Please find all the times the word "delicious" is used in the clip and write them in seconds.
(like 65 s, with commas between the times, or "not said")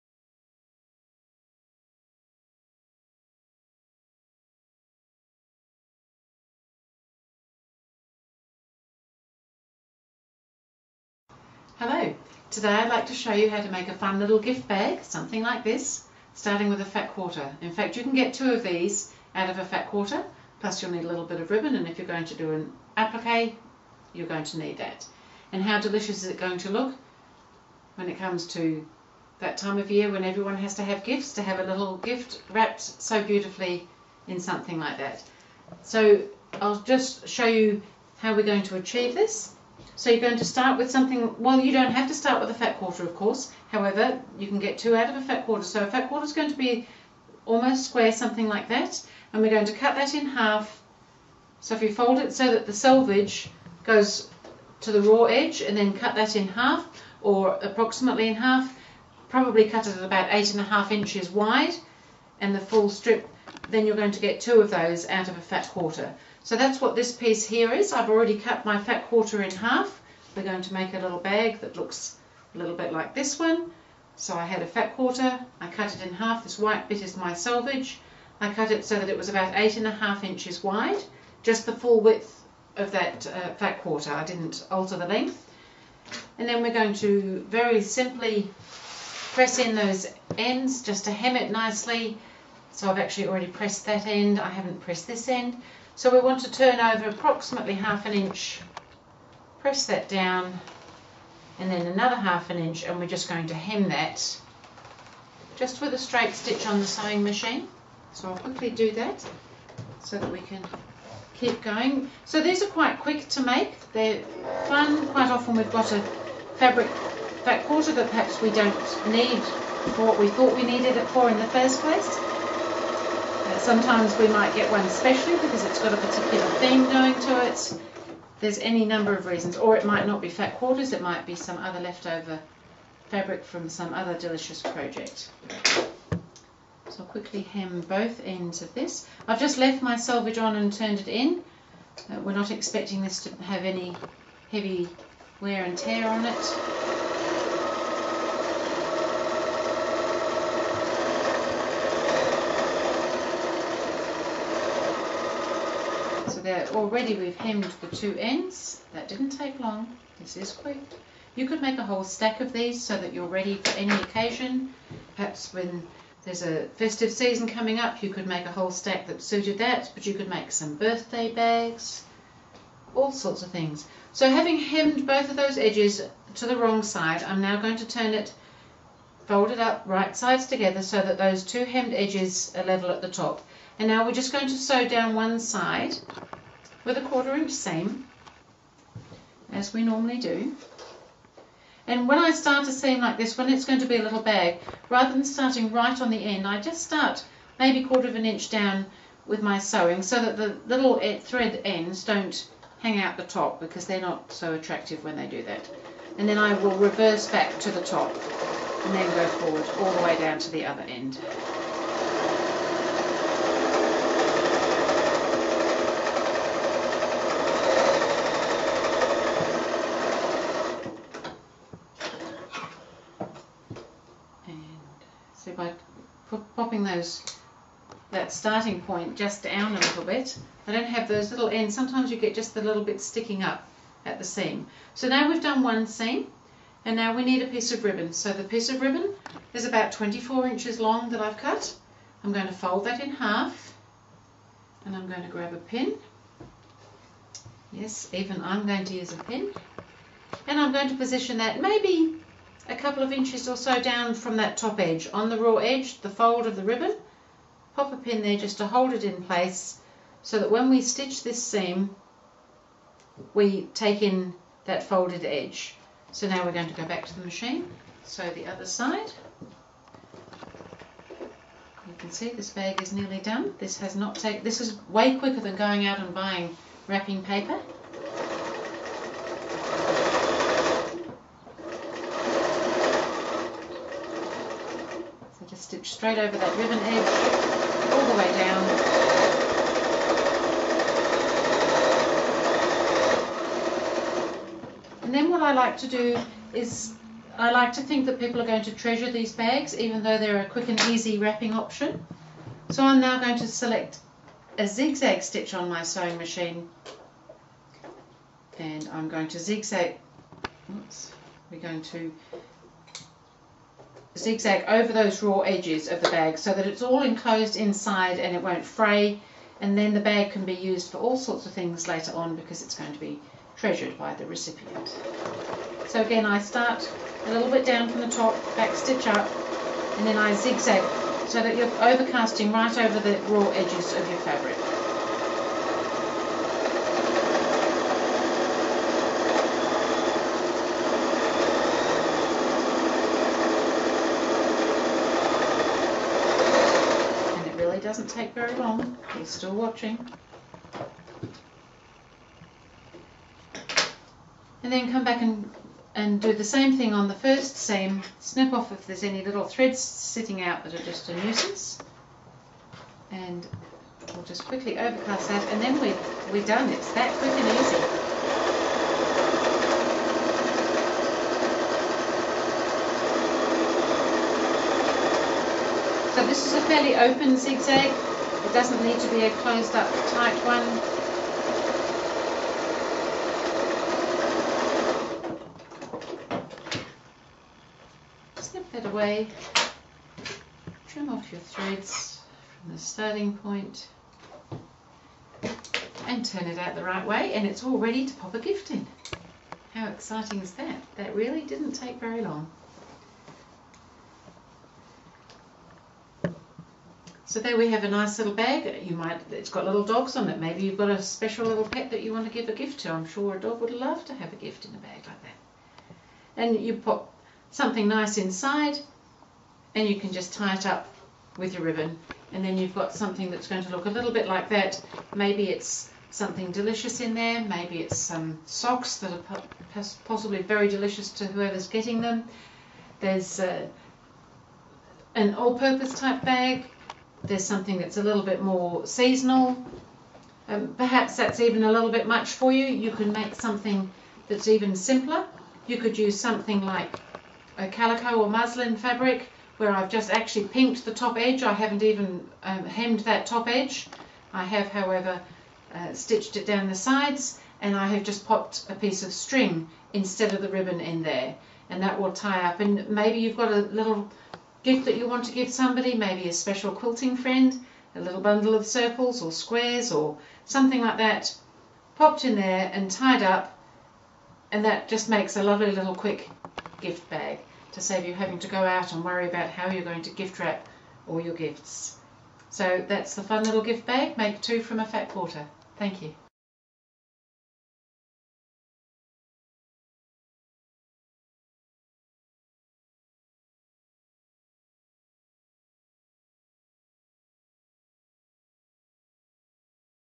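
25 s, 134 s, 426 s, 430 s.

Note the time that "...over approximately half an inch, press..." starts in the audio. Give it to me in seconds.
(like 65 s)
96 s.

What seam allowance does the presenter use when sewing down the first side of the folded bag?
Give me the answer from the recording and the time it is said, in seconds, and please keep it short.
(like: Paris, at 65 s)
quarter inch, at 187 s.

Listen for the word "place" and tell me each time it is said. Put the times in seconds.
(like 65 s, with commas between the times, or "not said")
121 s, 259 s.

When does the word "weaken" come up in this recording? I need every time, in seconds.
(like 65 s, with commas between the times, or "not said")
not said.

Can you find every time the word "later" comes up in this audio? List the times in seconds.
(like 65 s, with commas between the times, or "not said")
321 s.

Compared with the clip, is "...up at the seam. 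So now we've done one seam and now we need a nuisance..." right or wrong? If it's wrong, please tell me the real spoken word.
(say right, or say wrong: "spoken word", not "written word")
wrong: "piece", not "nuisance".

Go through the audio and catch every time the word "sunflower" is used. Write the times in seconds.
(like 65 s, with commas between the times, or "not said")
not said.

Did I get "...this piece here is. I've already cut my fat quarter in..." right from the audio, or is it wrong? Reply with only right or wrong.
right.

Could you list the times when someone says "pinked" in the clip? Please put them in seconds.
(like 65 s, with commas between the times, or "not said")
450 s.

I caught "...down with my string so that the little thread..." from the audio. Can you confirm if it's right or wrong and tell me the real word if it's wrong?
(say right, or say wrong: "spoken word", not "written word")
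wrong: "sewing", not "string".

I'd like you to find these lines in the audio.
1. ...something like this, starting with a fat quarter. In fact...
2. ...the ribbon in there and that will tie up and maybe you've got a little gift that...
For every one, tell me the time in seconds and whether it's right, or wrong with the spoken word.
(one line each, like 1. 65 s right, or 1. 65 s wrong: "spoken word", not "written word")
1. 15 s right
2. 460 s right.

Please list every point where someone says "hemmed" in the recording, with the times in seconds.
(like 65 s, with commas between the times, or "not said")
157 s, 174 s, 181 s, 452 s.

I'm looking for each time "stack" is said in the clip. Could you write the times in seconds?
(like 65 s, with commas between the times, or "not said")
162 s, 168 s.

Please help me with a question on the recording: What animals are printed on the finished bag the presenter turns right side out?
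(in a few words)
dogs.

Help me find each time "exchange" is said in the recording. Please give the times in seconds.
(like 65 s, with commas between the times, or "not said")
not said.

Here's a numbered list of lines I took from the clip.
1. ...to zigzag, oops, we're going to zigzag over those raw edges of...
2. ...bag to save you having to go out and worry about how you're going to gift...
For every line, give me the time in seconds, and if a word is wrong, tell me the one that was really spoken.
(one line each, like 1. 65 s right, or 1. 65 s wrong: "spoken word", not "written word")
1. 309 s right
2. 477 s right.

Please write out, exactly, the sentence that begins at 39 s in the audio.
So you're going to start with something, well, you don't have to start with a fat quarter, of course.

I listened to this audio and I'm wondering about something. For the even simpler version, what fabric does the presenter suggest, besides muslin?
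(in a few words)
calico.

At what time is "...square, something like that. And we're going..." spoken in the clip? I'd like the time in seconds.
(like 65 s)
47 s.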